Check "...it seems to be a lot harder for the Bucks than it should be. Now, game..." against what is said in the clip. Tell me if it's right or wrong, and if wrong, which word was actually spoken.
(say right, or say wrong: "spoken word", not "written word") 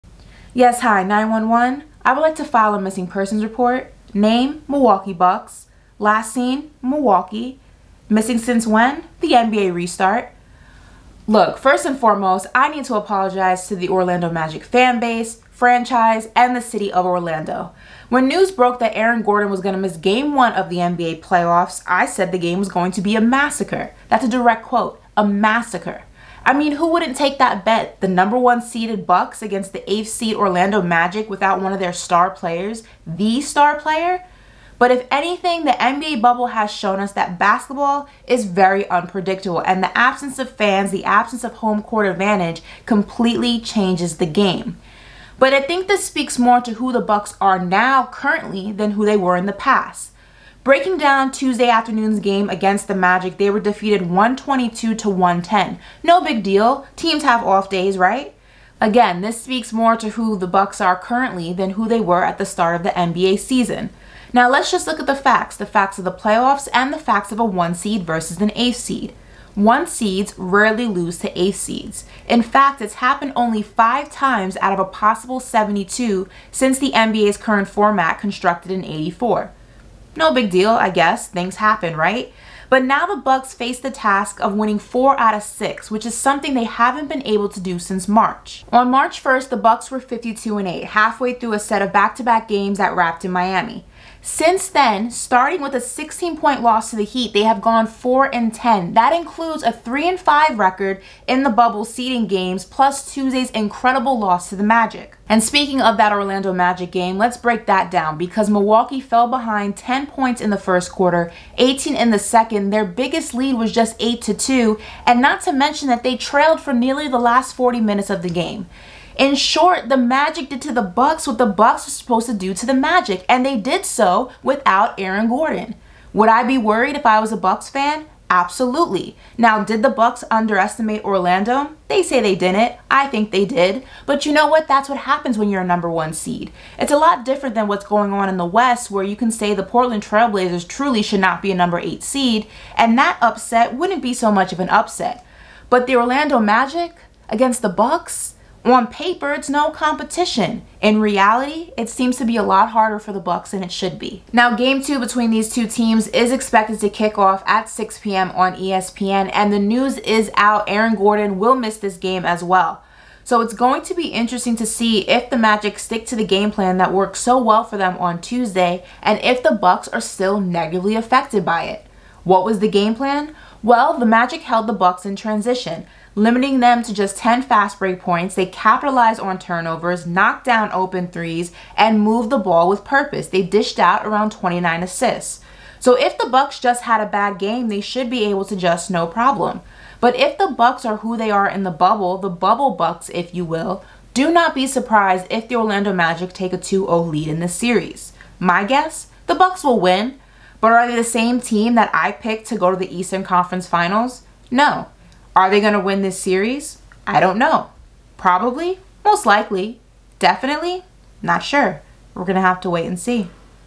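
right.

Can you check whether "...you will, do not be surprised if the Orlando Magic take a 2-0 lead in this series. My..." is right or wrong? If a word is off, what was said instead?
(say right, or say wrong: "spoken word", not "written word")
right.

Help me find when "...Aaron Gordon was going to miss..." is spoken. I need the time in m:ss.
0:18.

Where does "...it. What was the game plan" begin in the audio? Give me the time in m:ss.
2:51.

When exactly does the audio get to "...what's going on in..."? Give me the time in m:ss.
2:17.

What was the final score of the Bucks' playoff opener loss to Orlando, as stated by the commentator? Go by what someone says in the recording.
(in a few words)
122 to 110.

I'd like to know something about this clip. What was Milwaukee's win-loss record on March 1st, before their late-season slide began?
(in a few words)
52 and 8.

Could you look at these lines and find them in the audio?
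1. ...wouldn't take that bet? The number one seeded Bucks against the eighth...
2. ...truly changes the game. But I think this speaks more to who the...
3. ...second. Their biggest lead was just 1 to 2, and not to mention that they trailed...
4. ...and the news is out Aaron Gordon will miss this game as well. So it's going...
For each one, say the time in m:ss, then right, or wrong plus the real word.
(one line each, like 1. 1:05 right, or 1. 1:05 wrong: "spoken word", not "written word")
1. 0:26 right
2. 0:42 wrong: "completely", not "truly"
3. 1:52 wrong: "8", not "1"
4. 2:39 right.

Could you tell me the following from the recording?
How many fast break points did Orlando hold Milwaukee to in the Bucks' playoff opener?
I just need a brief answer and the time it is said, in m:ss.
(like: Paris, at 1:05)
10, at 2:57.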